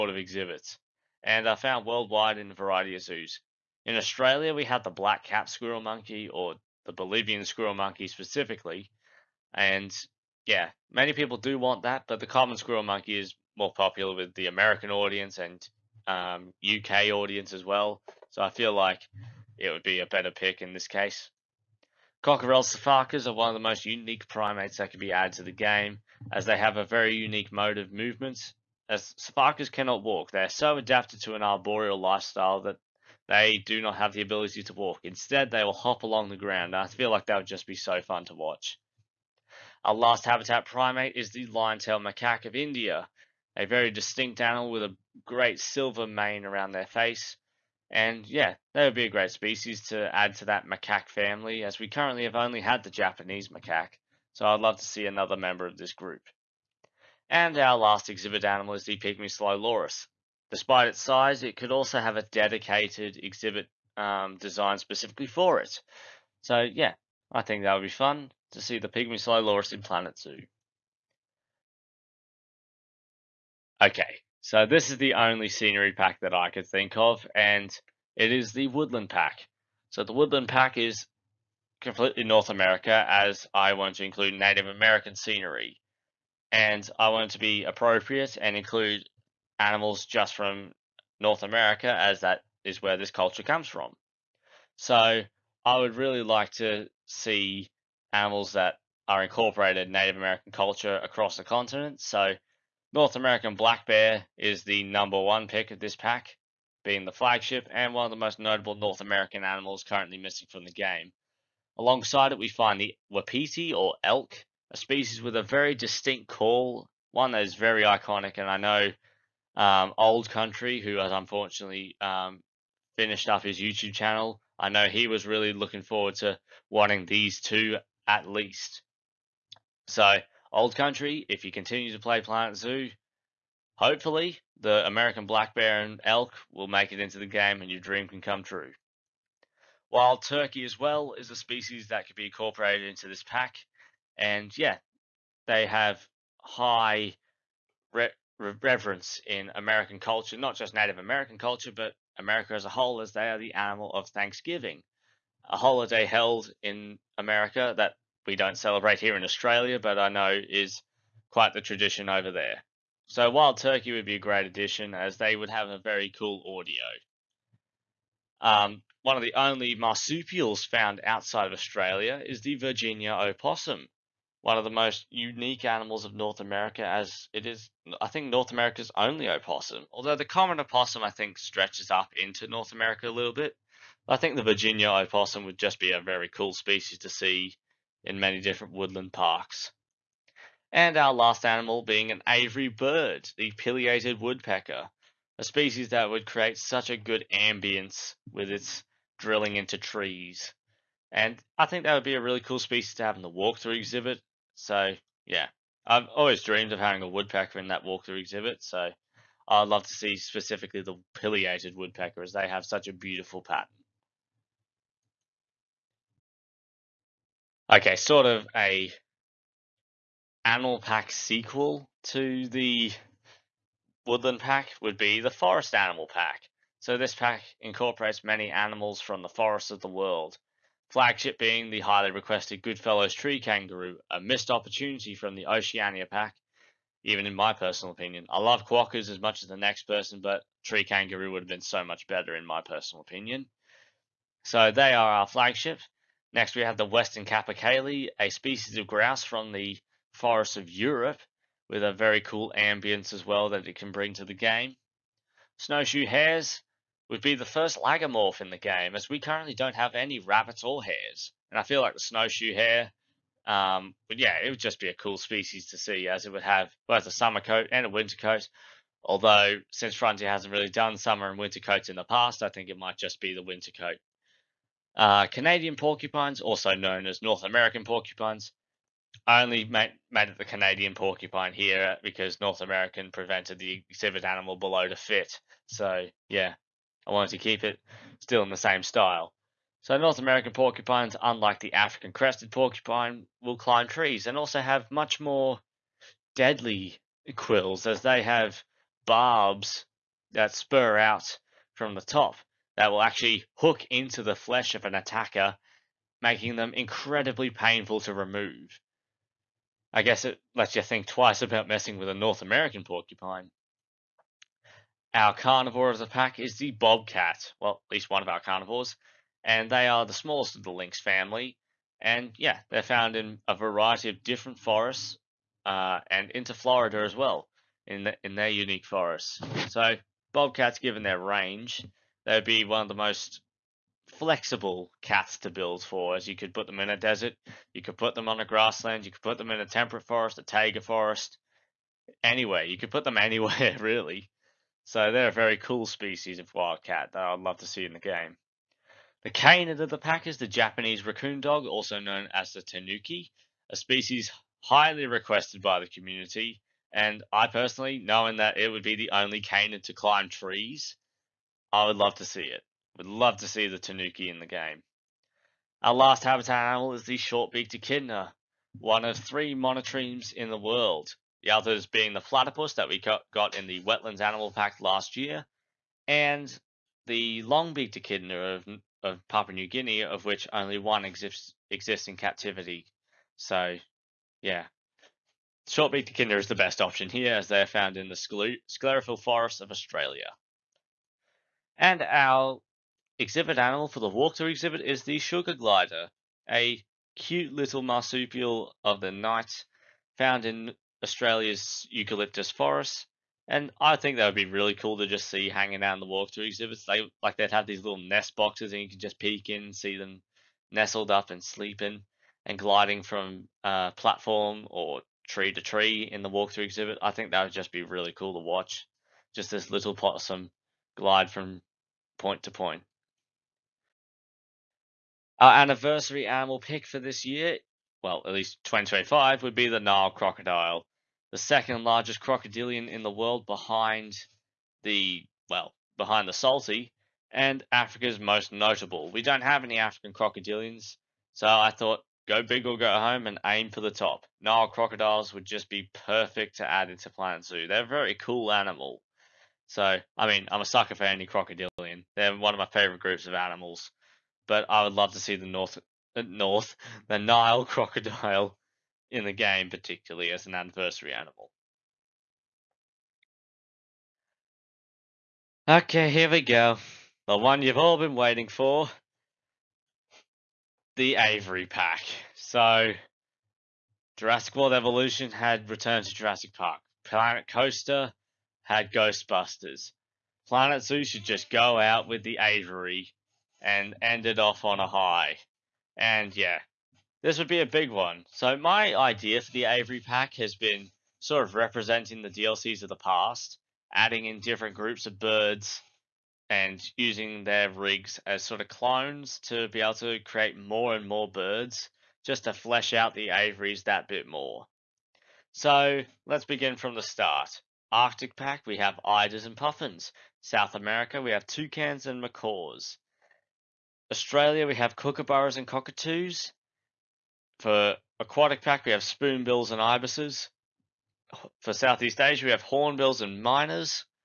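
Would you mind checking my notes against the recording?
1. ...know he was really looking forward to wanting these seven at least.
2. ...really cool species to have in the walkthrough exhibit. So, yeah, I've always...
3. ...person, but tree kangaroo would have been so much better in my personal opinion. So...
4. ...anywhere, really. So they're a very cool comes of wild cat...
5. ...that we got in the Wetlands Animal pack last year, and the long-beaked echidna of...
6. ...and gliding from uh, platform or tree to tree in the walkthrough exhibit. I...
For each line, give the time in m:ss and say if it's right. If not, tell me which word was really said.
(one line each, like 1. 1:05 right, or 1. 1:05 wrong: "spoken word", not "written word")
1. 2:04 wrong: "two", not "seven"
2. 3:22 right
3. 3:59 right
4. 5:43 wrong: "species", not "comes"
5. 6:12 right
6. 6:52 right.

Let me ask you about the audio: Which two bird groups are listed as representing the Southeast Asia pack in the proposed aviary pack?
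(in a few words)
hornbills and mynas.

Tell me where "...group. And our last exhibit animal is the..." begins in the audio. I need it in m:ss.
0:55.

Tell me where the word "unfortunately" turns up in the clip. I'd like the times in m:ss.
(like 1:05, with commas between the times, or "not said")
2:01.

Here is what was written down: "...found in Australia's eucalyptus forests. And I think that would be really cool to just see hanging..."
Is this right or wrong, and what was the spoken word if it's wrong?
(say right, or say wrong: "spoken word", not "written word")
right.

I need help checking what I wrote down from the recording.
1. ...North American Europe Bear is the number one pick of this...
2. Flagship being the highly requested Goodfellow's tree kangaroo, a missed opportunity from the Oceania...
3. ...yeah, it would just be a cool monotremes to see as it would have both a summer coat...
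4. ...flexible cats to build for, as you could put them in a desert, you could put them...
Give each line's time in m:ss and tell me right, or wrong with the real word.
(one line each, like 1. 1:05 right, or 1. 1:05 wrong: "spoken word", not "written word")
1. 1:42 wrong: "Black", not "Europe"
2. 3:50 right
3. 4:24 wrong: "species", not "monotremes"
4. 5:34 right.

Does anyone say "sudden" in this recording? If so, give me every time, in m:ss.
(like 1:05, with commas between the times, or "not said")
not said.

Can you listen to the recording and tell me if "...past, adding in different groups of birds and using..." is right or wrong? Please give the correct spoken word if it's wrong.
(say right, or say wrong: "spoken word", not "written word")
right.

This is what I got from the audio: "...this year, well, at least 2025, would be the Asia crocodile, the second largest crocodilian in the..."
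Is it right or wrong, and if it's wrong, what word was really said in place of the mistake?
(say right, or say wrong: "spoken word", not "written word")
wrong: "Nile", not "Asia".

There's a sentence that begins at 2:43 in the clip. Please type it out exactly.
So Wild Turkey would be a great addition as they would have a very cool audio.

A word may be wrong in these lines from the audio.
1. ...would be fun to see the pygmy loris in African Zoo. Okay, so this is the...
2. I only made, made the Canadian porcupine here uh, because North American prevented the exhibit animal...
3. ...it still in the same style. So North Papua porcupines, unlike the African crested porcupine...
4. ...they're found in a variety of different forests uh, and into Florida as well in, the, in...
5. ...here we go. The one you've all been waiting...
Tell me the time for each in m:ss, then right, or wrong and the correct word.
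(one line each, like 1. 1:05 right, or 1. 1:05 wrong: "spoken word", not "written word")
1. 1:07 wrong: "Planet", not "African"
2. 4:39 right
3. 4:47 wrong: "American", not "Papua"
4. 5:22 right
5. 7:46 right.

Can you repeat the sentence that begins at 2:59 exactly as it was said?
Although the common opossum, I think, stretches up into North America a little bit.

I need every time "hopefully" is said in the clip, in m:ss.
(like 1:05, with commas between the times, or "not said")
2:13.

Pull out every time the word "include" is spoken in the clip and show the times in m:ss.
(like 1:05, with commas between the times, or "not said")
1:24, 1:28.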